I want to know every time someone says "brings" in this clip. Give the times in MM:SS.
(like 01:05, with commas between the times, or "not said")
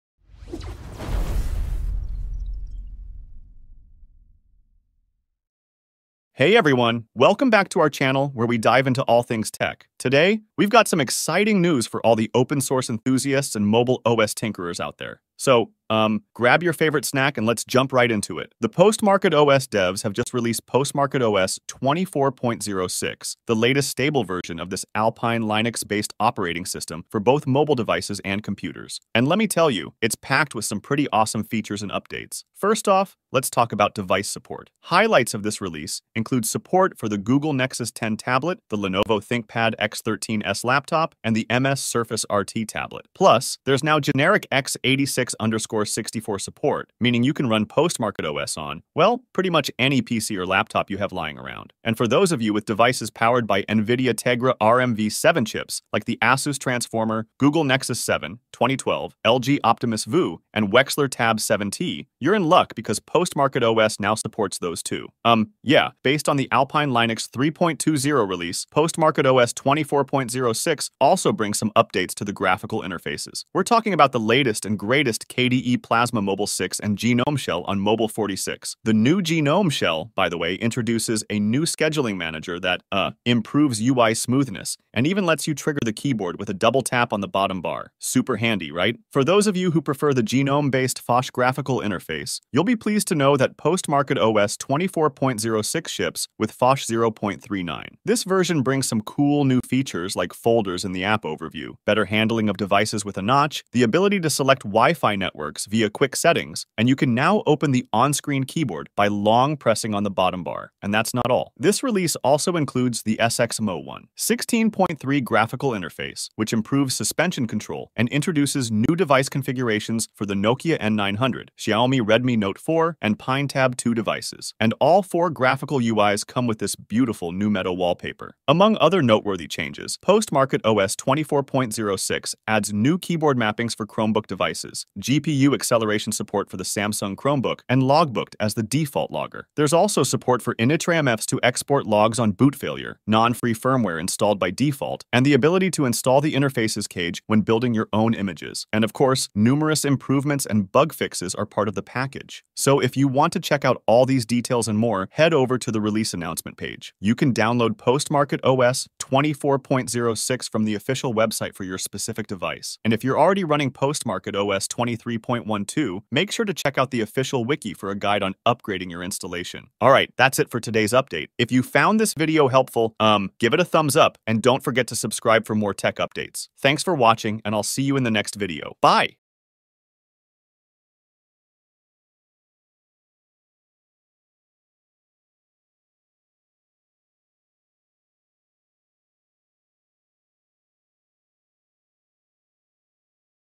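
01:11, 01:38.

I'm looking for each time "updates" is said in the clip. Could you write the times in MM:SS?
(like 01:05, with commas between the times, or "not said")
00:31, 01:11, 02:50, 02:55.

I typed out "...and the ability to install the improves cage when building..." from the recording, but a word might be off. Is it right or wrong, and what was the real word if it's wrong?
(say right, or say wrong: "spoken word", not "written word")
wrong: "interfaces", not "improves".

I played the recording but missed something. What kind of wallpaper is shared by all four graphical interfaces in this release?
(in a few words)
metal wallpaper.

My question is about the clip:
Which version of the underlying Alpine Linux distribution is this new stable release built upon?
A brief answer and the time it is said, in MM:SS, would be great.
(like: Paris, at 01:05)
3.20, at 01:06.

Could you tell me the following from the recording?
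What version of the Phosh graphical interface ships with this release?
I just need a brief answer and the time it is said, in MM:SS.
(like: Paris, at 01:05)
0.39, at 01:36.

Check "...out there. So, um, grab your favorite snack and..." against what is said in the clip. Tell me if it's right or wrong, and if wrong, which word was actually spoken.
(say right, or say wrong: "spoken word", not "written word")
right.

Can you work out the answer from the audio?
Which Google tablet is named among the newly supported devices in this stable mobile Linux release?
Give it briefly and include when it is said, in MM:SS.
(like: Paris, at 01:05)
Nexus 10, at 00:37.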